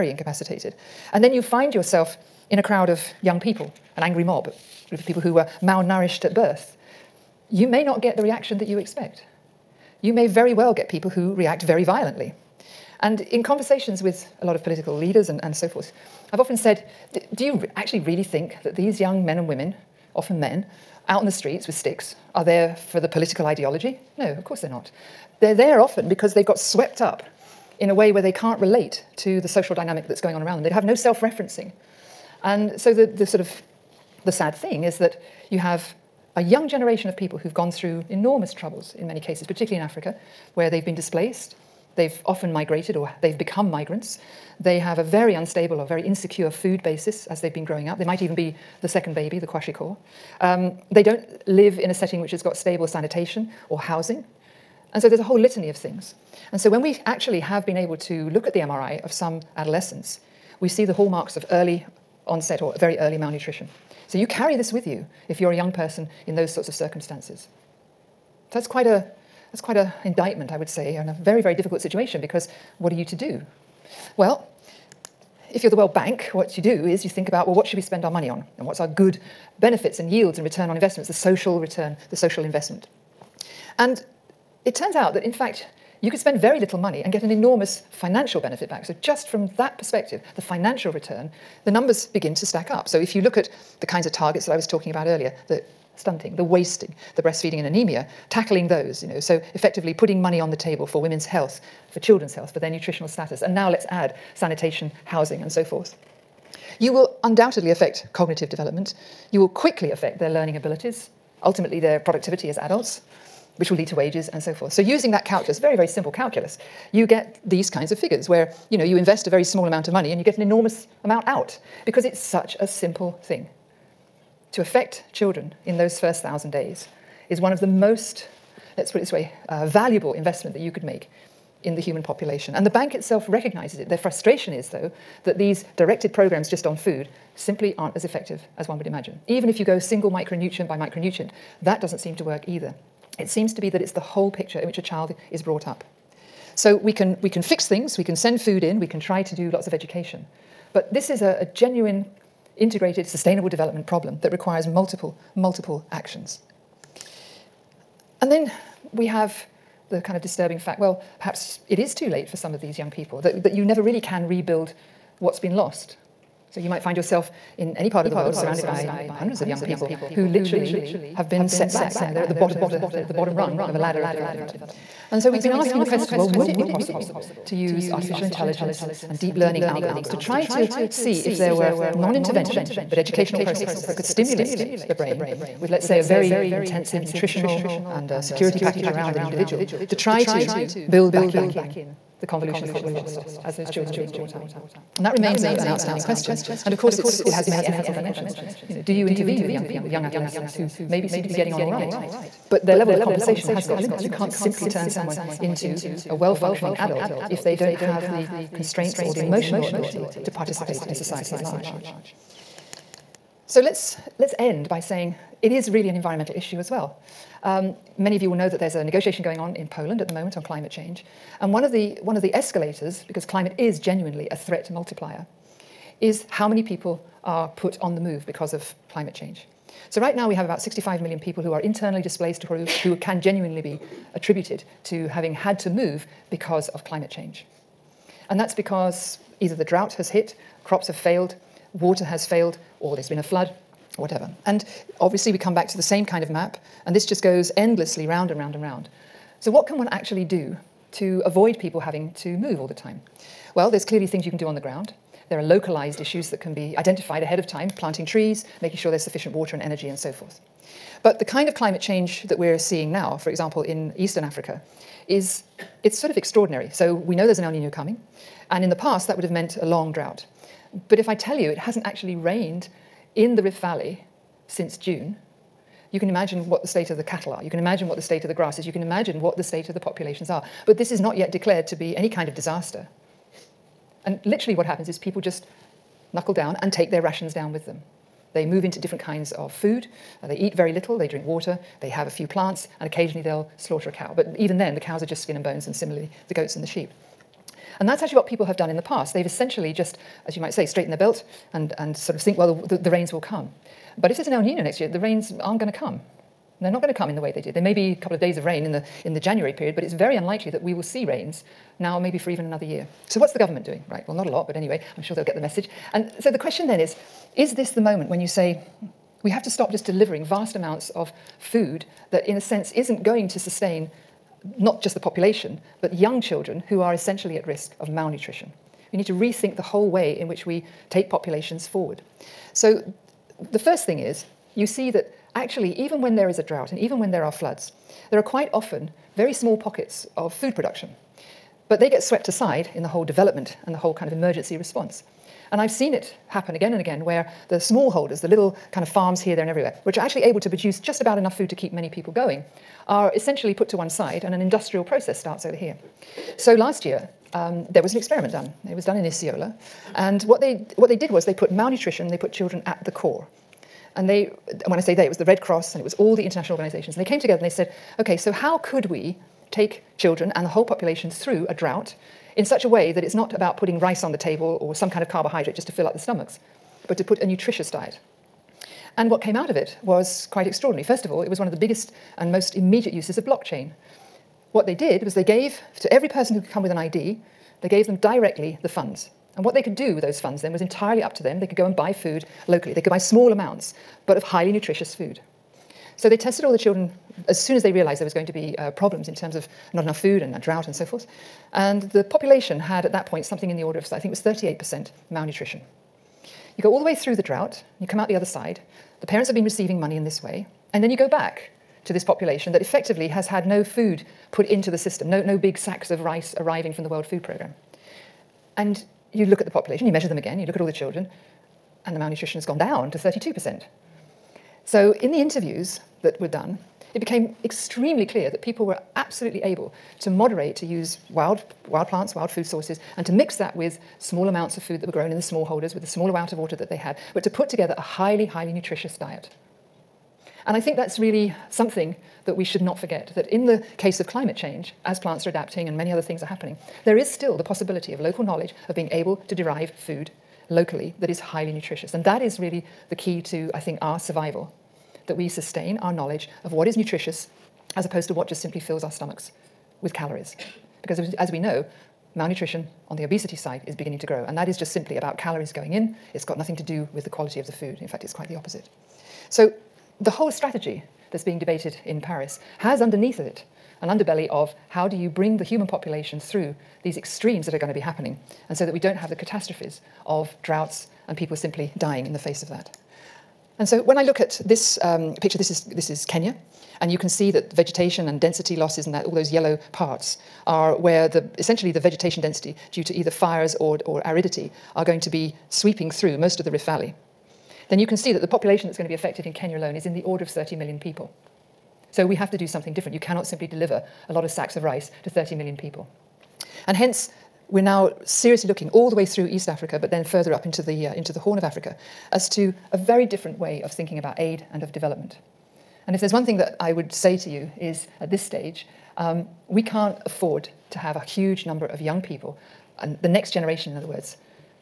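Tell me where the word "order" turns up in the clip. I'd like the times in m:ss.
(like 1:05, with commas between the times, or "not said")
6:43, 8:20.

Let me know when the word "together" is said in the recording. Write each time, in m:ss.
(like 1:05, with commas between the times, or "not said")
6:07, 7:17.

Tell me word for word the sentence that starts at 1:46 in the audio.
You will undoubtedly affect cognitive development.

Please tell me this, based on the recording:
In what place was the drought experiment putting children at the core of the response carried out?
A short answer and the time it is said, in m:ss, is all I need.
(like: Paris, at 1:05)
Isiolo, at 5:59.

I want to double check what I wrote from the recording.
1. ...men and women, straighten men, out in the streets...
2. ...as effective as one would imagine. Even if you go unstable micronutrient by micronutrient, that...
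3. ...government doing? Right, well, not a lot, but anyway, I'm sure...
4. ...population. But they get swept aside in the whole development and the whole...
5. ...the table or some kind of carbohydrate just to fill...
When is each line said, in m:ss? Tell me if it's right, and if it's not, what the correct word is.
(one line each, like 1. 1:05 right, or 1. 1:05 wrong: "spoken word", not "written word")
1. 0:19 wrong: "often", not "straighten"
2. 2:17 wrong: "single", not "unstable"
3. 5:13 right
4. 5:40 wrong: "production", not "population"
5. 6:14 right.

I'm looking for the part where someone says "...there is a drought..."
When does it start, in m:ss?
5:36.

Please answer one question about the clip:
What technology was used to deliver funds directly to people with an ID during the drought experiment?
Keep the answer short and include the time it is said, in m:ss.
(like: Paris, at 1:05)
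blockchain, at 6:23.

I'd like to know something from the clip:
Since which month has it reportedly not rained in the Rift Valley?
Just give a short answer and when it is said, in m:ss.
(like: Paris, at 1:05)
June, at 4:34.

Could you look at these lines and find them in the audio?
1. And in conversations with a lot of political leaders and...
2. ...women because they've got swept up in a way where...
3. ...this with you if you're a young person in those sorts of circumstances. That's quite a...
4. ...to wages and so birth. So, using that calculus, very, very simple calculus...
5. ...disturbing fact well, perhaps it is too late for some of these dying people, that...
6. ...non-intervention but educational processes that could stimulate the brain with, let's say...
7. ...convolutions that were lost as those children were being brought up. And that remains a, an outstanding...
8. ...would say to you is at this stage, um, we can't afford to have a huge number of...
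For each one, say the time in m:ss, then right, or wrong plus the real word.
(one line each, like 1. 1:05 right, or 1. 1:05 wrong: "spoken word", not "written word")
1. 0:12 right
2. 0:25 wrong: "often", not "women"
3. 1:04 right
4. 1:53 wrong: "forth", not "birth"
5. 2:40 wrong: "young", not "dying"
6. 3:01 right
7. 3:12 right
8. 8:36 right.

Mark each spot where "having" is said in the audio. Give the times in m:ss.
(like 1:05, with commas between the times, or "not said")
3:55, 4:11.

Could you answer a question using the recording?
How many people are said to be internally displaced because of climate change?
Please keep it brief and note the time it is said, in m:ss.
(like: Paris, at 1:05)
65 million, at 3:50.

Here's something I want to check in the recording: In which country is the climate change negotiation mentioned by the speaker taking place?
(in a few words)
Poland.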